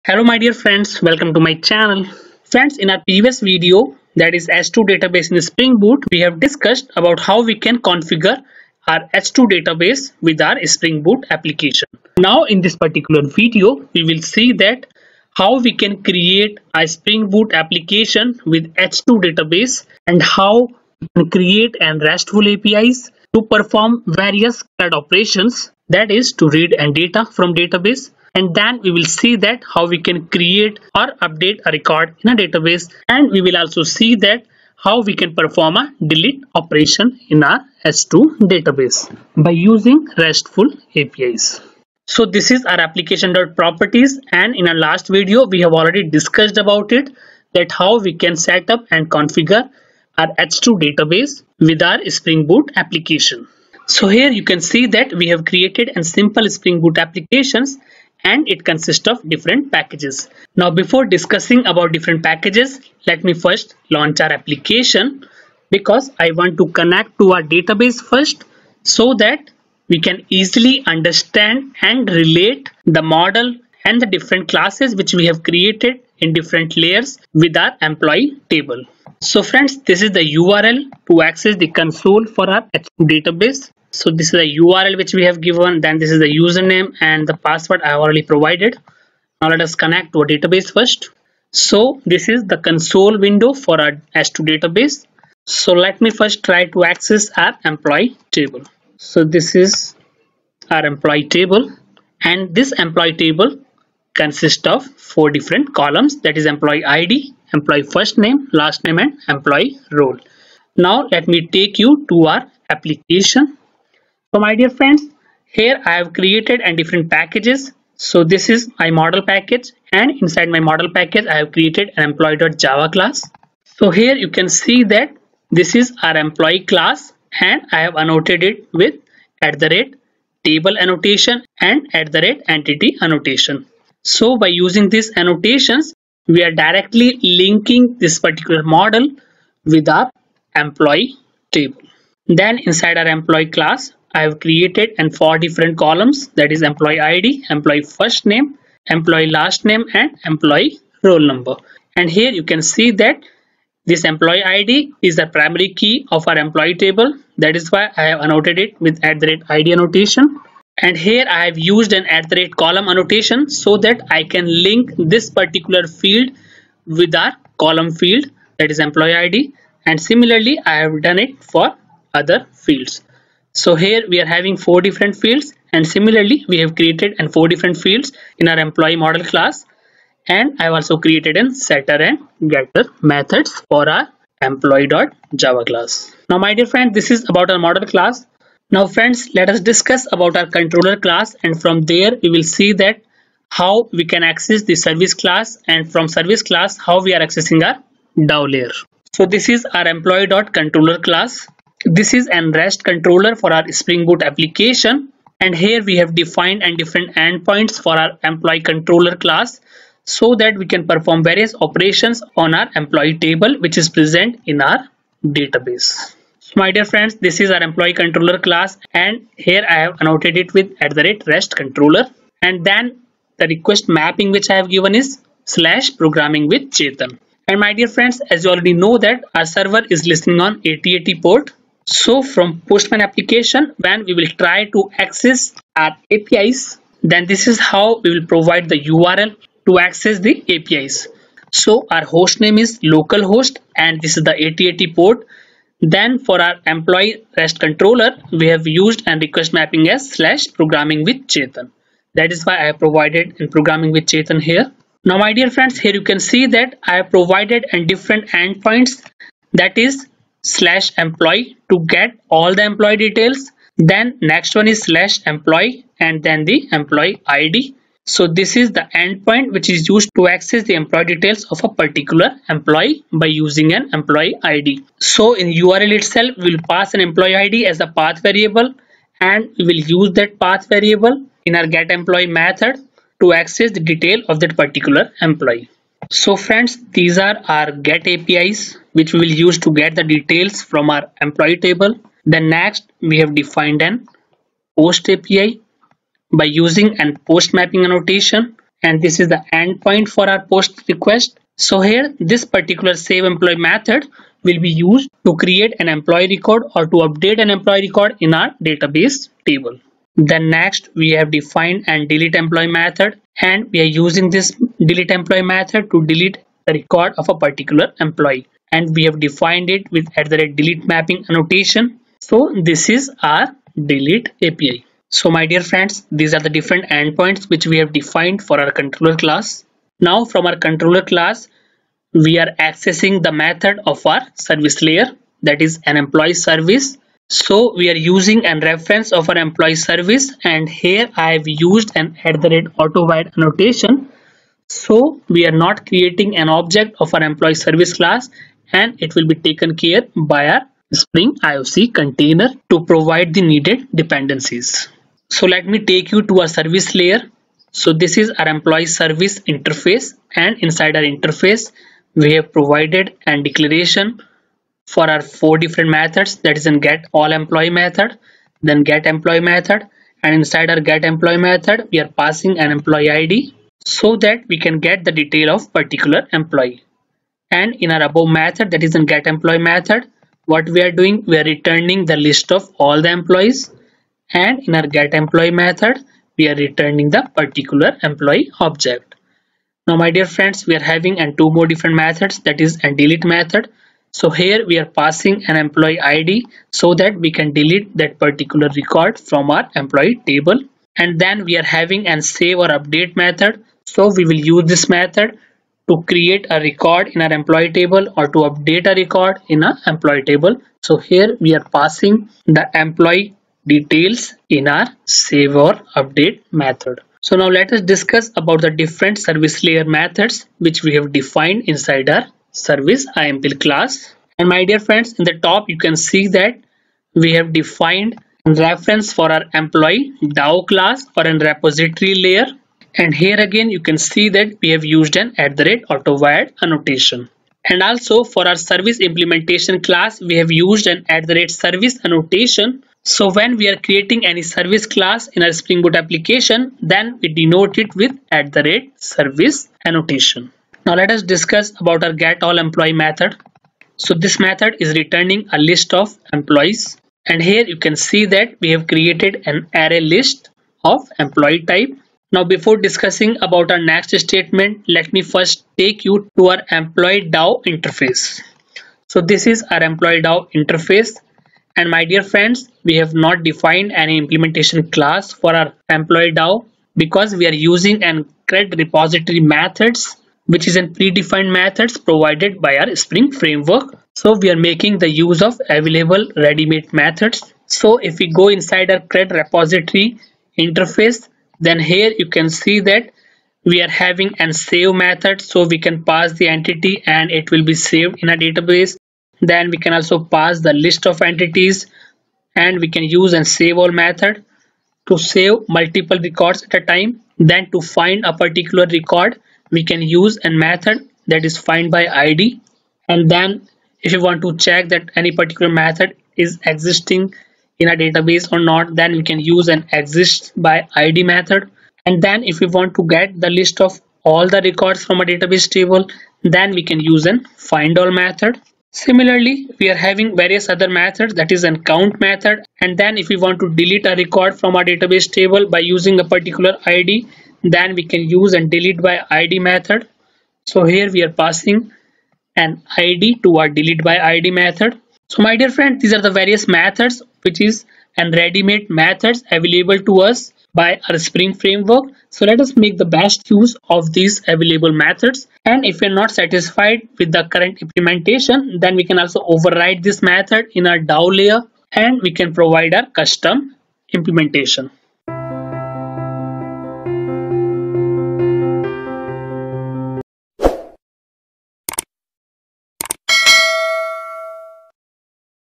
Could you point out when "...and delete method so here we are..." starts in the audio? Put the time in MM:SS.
06:32.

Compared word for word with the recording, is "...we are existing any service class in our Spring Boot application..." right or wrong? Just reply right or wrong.
wrong.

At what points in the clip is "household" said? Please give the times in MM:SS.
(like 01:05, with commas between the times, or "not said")
not said.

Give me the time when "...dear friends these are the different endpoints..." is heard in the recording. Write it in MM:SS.
05:25.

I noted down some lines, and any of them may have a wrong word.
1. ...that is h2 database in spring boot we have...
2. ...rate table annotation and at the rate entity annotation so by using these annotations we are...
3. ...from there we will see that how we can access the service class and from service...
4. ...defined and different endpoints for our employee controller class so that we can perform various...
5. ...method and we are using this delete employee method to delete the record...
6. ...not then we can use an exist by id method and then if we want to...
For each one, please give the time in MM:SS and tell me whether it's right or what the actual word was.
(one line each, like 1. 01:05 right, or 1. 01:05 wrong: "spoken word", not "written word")
1. 00:04 right
2. 02:09 right
3. 03:11 right
4. 03:26 right
5. 05:12 right
6. 08:38 right.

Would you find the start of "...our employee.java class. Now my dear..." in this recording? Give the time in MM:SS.
03:03.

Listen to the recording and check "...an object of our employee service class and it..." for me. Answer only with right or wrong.
right.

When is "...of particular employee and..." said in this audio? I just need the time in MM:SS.
06:15.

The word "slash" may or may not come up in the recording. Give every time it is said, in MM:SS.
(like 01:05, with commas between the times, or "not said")
03:45, 04:10, 04:20, 04:24.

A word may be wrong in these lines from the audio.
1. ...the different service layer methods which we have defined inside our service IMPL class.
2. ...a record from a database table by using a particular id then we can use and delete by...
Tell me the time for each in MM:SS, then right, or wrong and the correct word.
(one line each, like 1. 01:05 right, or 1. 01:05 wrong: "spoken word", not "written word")
1. 06:58 right
2. 08:54 right.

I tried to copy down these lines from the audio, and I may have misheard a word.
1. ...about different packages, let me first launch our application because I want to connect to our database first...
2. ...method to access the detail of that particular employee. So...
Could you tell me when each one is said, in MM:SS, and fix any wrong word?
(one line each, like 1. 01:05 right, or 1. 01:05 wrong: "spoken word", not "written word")
1. 01:01 right
2. 04:42 right.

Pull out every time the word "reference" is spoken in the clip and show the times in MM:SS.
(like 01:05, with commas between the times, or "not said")
05:38, 07:08.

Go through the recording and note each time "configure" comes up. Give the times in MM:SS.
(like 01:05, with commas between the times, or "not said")
00:07, 00:49.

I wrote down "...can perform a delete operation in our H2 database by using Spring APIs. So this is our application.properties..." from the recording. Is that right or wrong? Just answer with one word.
wrong.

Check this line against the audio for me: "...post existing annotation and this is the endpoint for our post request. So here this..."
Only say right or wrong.
wrong.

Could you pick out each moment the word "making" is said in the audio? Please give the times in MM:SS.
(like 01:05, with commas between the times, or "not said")
08:04.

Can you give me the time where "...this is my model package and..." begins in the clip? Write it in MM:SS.
01:58.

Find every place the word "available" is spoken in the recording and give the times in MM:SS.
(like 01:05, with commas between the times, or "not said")
08:05, 09:09, 09:14.